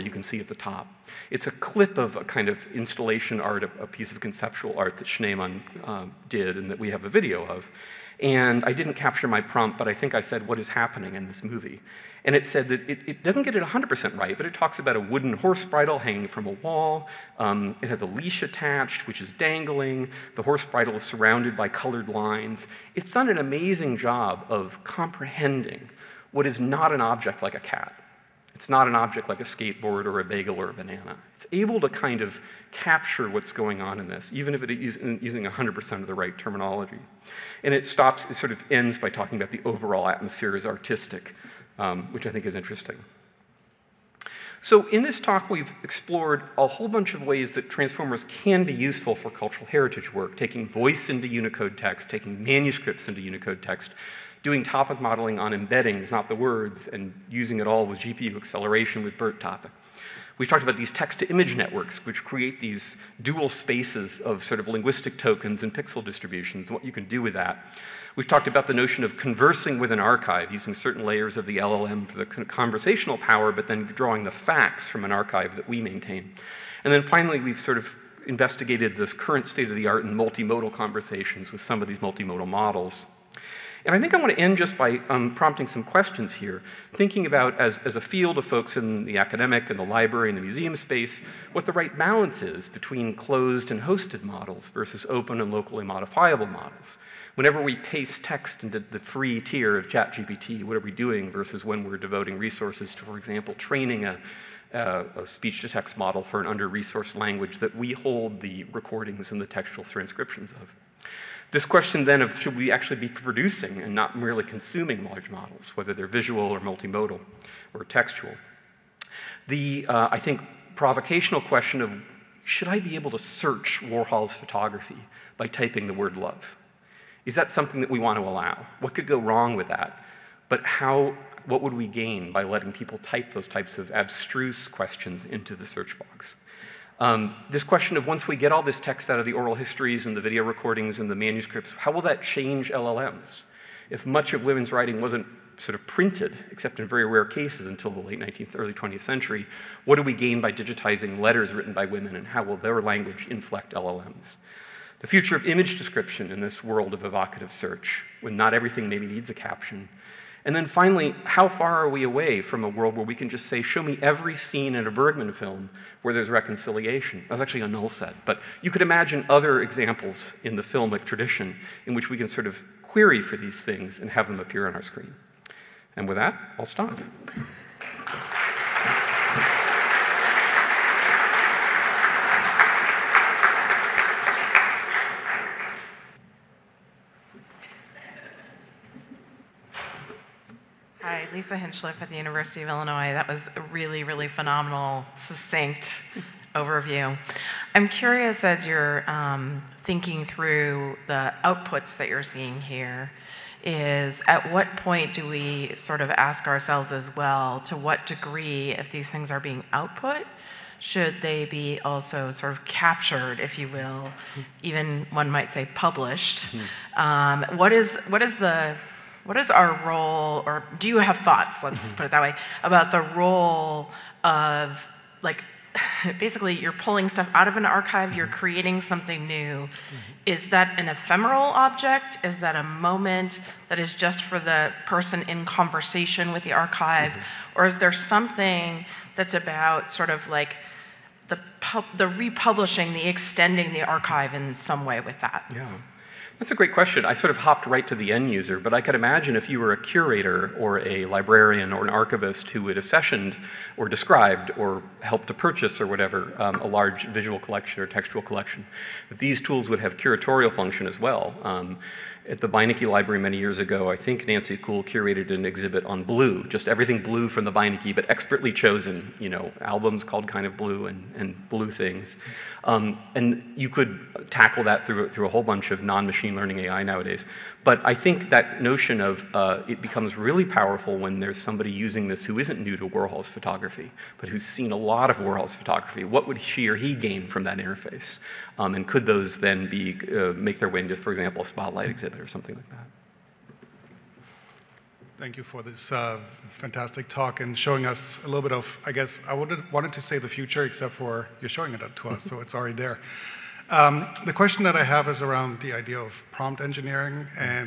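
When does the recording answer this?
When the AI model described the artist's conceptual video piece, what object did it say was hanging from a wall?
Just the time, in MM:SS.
00:14.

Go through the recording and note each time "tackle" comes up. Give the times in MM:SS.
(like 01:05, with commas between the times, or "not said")
04:34.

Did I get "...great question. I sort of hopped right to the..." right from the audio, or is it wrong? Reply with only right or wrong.
right.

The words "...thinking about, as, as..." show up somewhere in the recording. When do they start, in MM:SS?
01:26.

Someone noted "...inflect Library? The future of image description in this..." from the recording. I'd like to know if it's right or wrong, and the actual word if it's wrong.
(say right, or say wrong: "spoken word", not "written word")
wrong: "LLMs", not "Library".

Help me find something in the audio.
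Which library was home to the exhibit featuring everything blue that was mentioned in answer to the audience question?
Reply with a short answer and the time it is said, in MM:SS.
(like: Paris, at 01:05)
Beinecke Library, at 04:22.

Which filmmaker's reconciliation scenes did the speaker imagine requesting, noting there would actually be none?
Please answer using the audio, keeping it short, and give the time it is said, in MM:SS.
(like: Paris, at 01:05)
Bergman, at 02:44.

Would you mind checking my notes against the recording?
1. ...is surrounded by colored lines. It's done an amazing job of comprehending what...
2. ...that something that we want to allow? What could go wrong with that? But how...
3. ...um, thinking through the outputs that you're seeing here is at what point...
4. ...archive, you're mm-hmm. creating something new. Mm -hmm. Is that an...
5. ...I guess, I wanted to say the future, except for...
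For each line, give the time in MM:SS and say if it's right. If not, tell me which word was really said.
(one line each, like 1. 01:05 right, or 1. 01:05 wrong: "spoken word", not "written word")
1. 00:20 right
2. 02:07 right
3. 03:19 right
4. 03:47 right
5. 04:58 right.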